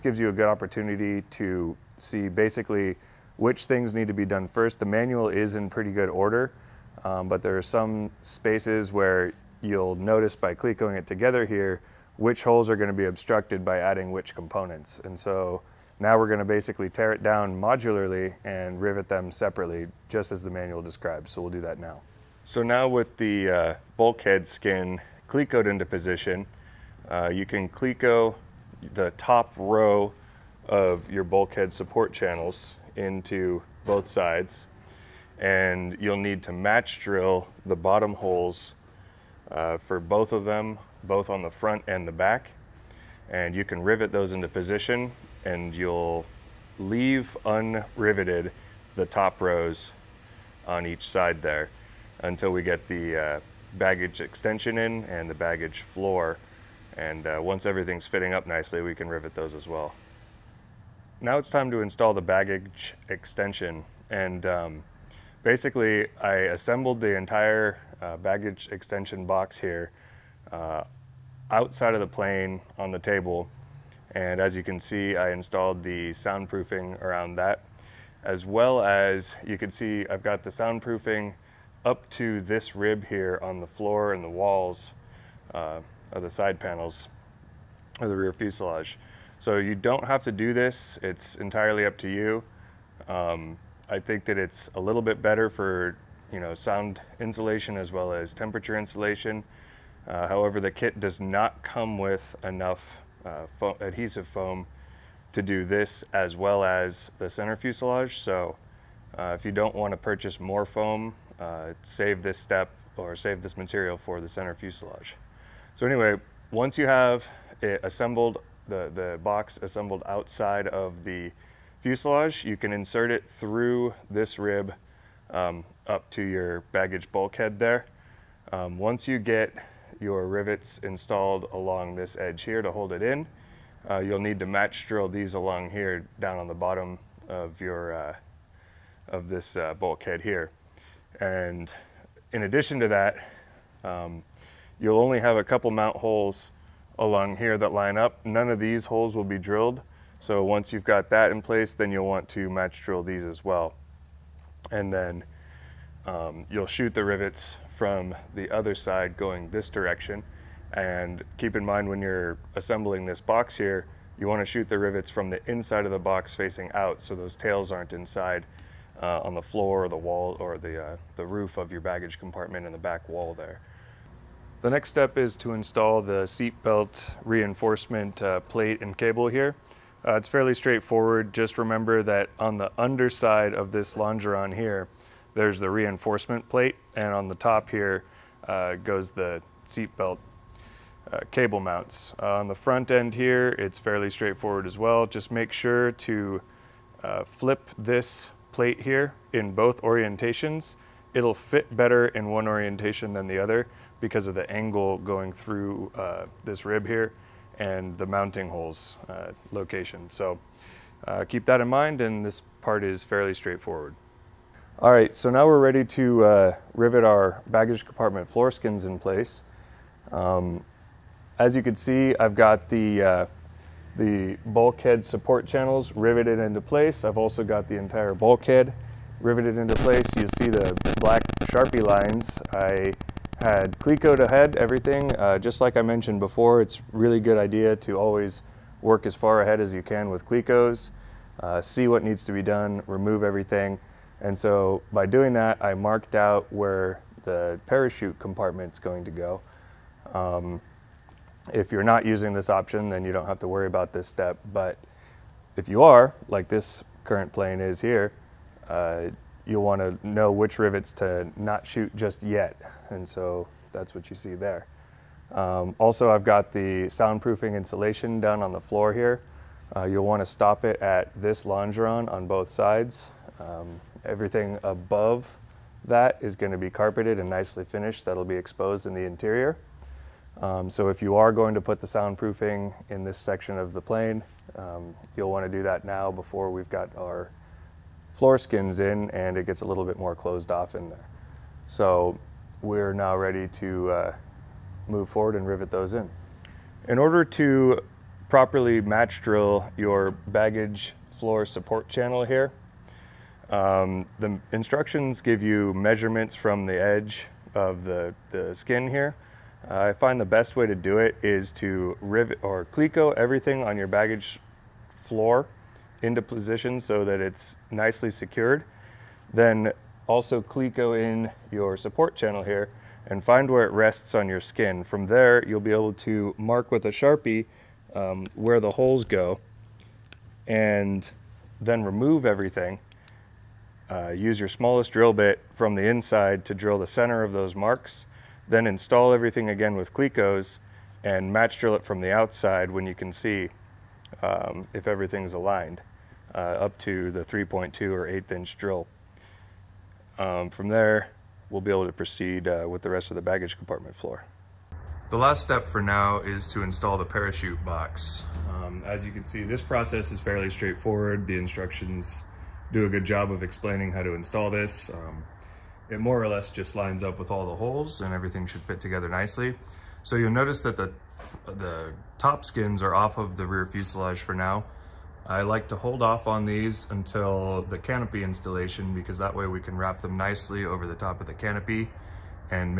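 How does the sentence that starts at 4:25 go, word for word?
Um, also, I've got the soundproofing insulation done on the floor here.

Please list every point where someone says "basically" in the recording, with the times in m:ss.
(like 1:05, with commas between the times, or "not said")
0:02, 0:16, 1:05.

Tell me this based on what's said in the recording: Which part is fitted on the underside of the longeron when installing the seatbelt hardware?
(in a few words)
Reinforcement plate.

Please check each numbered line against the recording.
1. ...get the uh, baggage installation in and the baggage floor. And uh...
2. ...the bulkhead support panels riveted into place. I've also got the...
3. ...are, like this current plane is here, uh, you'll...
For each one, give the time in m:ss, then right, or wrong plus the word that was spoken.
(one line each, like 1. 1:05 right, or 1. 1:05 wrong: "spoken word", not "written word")
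1. 0:52 wrong: "extension", not "installation"
2. 3:43 wrong: "channels", not "panels"
3. 4:15 right.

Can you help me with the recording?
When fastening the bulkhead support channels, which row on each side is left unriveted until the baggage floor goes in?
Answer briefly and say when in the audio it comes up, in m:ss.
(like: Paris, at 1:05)
Top rows, at 0:49.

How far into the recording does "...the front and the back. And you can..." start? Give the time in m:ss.
0:41.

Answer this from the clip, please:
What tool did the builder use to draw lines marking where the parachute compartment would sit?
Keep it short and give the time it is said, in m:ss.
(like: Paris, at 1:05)
Black Sharpie, at 3:51.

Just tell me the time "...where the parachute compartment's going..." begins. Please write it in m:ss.
4:06.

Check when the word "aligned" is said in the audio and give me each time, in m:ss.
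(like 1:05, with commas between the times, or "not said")
5:45.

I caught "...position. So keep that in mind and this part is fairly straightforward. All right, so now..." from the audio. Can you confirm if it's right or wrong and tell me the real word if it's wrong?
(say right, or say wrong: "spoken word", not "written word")
wrong: "location", not "position".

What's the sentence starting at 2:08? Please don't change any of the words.
Um, once you get your rivets installed along this edge here to hold it in.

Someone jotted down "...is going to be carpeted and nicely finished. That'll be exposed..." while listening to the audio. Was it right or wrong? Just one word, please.
right.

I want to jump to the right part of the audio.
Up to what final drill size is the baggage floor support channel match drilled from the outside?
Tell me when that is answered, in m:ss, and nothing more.
5:47.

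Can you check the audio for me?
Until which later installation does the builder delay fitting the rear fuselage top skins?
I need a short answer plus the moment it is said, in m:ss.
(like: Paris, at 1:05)
Canopy installation, at 6:17.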